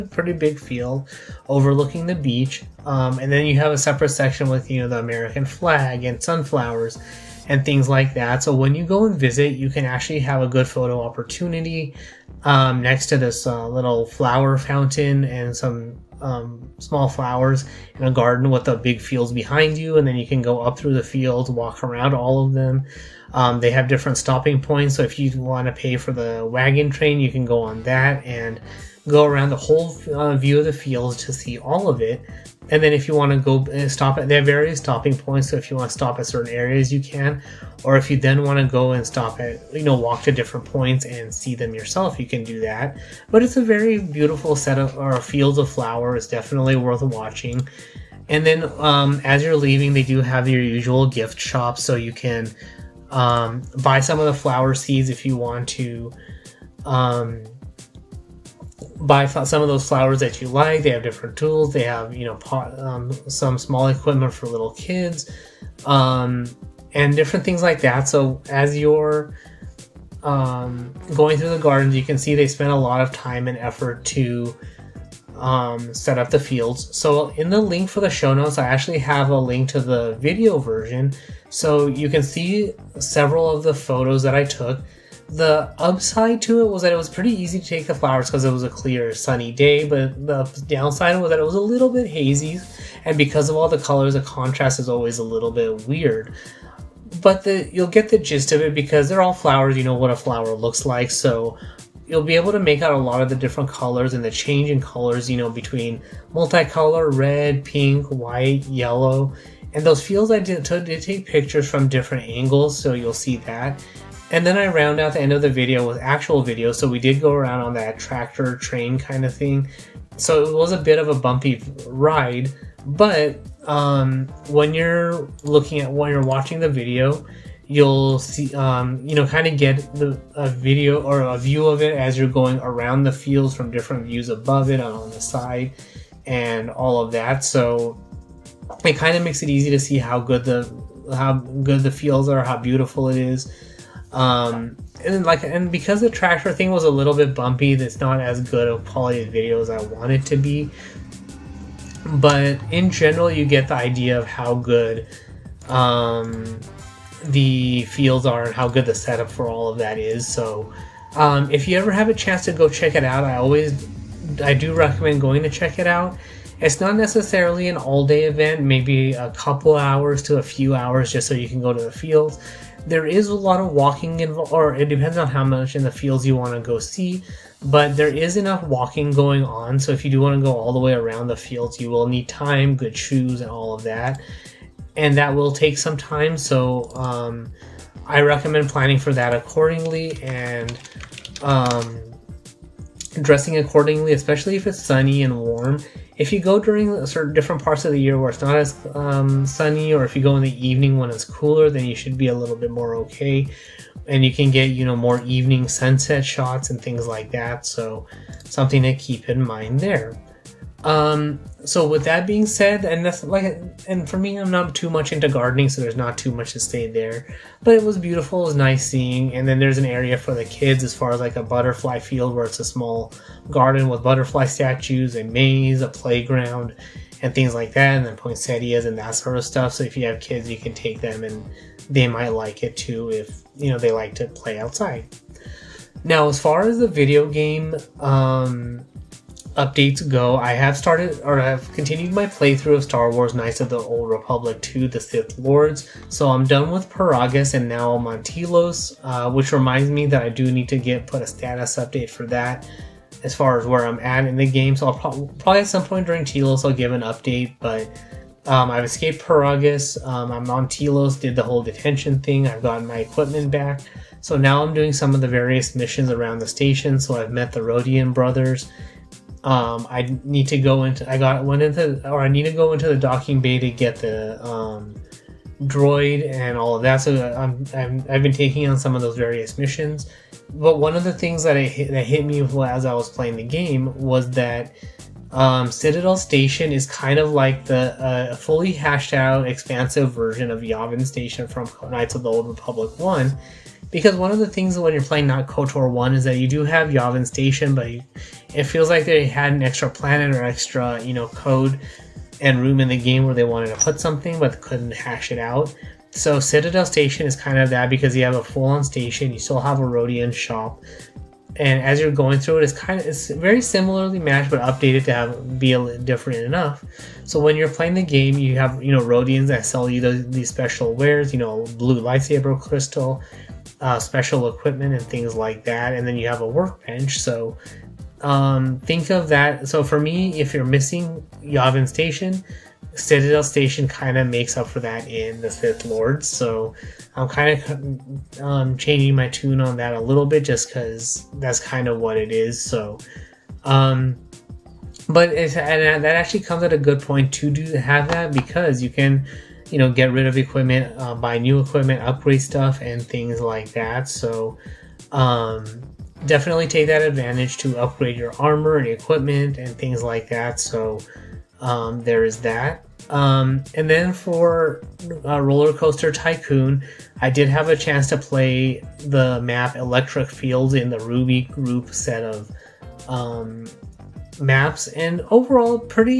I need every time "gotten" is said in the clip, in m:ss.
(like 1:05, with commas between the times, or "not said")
4:22.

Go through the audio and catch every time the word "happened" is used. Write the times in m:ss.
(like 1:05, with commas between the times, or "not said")
not said.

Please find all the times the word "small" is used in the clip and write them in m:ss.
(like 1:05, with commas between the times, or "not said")
0:16, 1:03, 3:42.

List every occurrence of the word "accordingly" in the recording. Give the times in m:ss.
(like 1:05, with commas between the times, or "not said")
3:09, 3:13.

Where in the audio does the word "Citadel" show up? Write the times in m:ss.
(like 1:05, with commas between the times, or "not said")
4:45, 5:06, 5:32.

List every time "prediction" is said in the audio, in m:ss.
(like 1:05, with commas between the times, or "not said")
not said.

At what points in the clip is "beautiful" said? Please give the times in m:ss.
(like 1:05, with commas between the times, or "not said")
0:43, 2:22, 3:37.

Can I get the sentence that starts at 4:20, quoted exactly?
Um, I'm on Telos, did the whole detention thing.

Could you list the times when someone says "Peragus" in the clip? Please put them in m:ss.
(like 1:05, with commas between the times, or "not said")
4:06, 4:19.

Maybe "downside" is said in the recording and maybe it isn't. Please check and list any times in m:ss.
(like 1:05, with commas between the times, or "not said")
1:30.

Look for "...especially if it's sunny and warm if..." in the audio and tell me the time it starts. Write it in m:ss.
3:14.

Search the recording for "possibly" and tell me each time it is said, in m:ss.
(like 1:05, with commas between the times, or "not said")
not said.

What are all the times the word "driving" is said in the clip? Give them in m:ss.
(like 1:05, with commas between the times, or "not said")
not said.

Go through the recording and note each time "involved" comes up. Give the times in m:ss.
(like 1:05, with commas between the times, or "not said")
2:54.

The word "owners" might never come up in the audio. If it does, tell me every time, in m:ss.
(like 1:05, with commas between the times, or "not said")
not said.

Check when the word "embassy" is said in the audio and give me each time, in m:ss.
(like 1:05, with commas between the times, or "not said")
not said.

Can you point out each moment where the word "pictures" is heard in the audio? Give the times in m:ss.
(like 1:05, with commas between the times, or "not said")
1:51.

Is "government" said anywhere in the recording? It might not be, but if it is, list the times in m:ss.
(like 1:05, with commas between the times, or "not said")
not said.